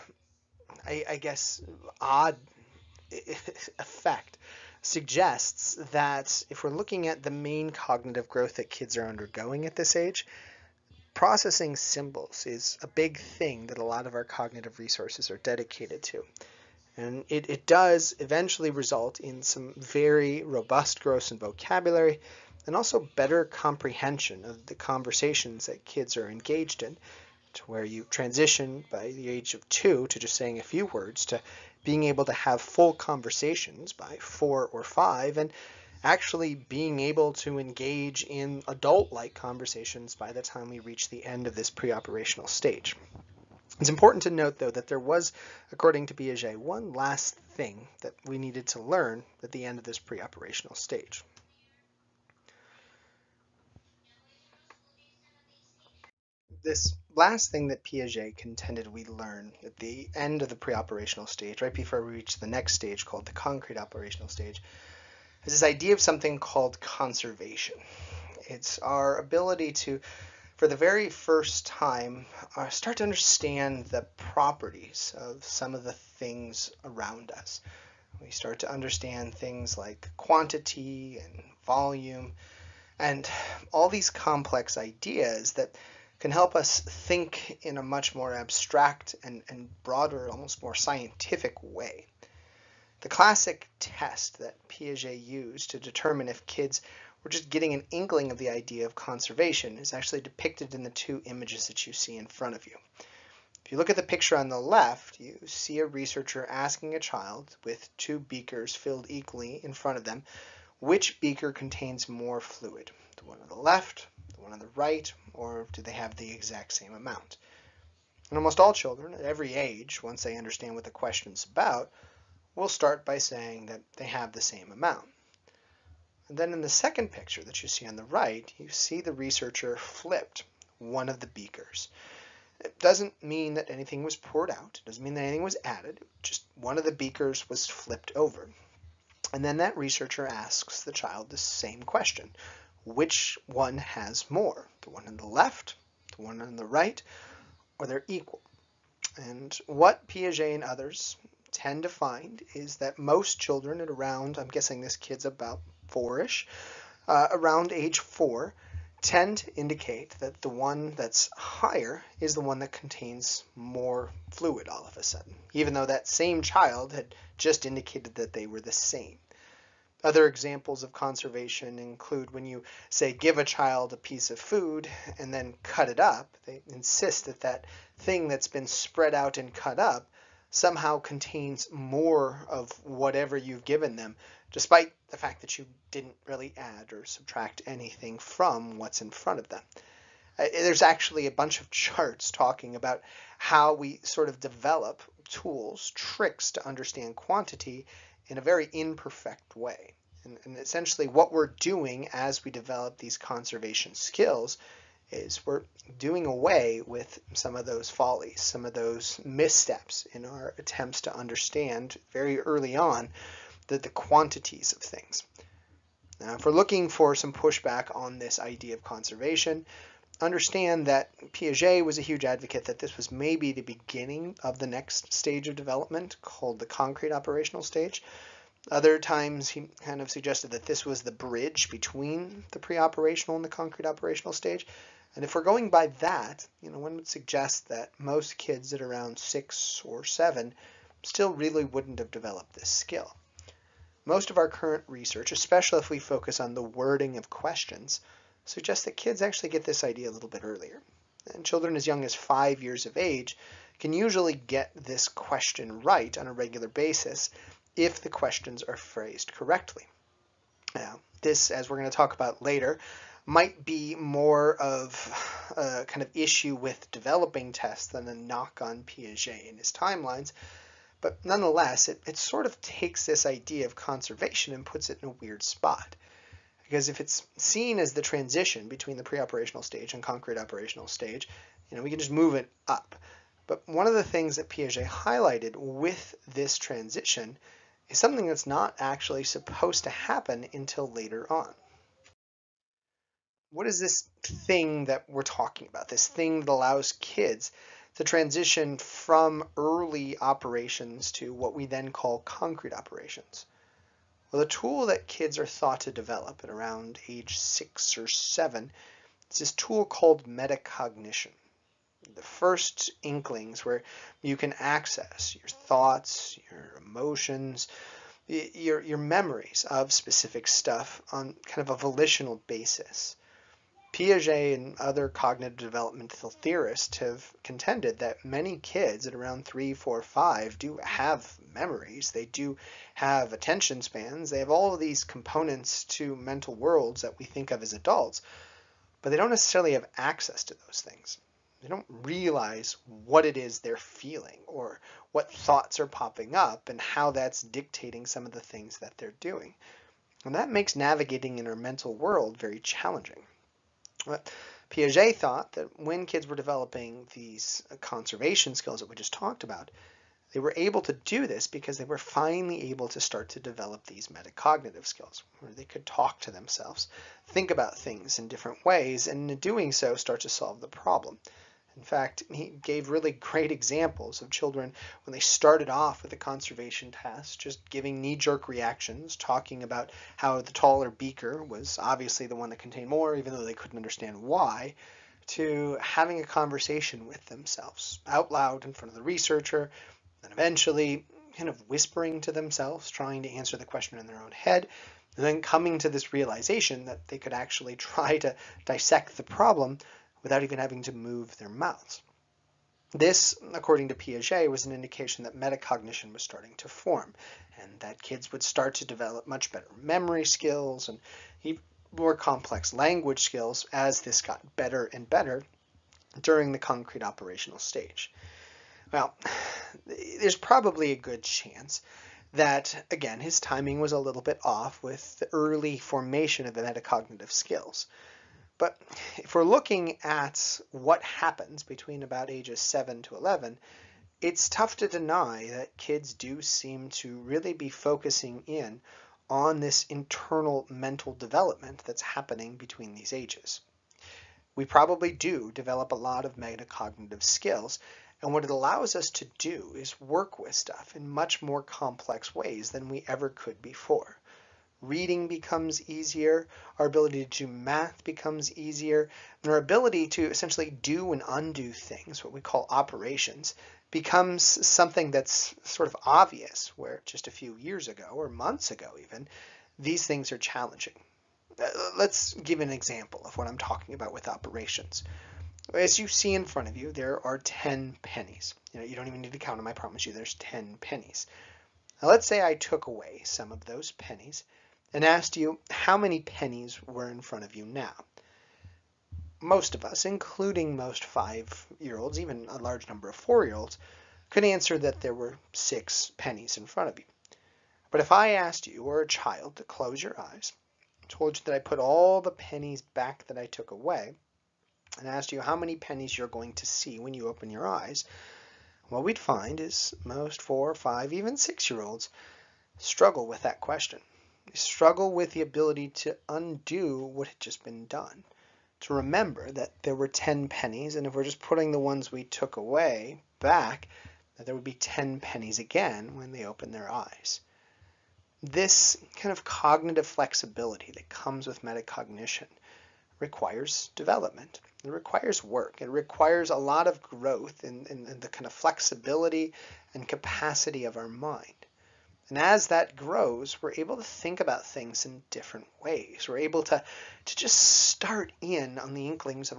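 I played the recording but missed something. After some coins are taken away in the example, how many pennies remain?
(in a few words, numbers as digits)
6.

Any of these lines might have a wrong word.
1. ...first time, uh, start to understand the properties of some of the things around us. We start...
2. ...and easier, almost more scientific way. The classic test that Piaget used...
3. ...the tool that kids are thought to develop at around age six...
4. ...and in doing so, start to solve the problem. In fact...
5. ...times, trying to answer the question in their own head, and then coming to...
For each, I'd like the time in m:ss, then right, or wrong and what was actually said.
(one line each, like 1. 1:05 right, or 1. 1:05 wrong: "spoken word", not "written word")
1. 1:11 right
2. 1:29 wrong: "broader", not "easier"
3. 5:04 right
4. 6:09 right
5. 6:32 wrong: "themselves", not "times".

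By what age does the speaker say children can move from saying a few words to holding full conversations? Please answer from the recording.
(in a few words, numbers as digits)
4 or 5.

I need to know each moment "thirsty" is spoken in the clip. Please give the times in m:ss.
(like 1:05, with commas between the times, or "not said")
not said.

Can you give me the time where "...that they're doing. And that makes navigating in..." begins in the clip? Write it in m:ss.
5:48.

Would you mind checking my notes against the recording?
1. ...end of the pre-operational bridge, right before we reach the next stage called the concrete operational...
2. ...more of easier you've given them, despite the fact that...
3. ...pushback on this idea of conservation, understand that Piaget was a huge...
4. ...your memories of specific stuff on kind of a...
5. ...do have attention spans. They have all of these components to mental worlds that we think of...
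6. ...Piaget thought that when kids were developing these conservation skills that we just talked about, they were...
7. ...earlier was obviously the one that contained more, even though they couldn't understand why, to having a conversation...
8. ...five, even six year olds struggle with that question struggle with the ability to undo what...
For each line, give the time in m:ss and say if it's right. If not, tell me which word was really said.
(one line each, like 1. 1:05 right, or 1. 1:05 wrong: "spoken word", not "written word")
1. 1:00 wrong: "stage", not "bridge"
2. 3:01 wrong: "whatever", not "easier"
3. 3:37 right
4. 5:18 right
5. 5:32 right
6. 5:54 right
7. 6:20 wrong: "beaker", not "earlier"
8. 8:30 right.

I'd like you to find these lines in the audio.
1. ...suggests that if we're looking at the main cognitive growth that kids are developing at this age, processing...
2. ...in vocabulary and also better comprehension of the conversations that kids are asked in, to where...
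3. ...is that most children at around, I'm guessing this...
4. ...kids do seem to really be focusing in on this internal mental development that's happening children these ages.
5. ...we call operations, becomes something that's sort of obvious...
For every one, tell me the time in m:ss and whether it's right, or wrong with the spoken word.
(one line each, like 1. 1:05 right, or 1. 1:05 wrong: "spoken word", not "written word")
1. 0:04 wrong: "undergoing", not "developing"
2. 0:21 wrong: "engaged", not "asked"
3. 2:32 right
4. 7:15 wrong: "between", not "children"
5. 7:42 right.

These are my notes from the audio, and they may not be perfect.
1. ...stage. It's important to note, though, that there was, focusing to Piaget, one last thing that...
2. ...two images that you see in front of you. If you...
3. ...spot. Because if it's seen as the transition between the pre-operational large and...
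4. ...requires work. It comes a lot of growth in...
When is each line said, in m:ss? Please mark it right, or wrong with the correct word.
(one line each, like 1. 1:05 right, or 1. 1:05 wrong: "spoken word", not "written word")
1. 0:42 wrong: "according", not "focusing"
2. 1:40 right
3. 4:35 wrong: "stage", not "large"
4. 8:54 wrong: "requires", not "comes".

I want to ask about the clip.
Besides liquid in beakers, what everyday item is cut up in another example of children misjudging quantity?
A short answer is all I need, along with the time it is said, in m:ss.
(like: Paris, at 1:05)
food, at 2:53.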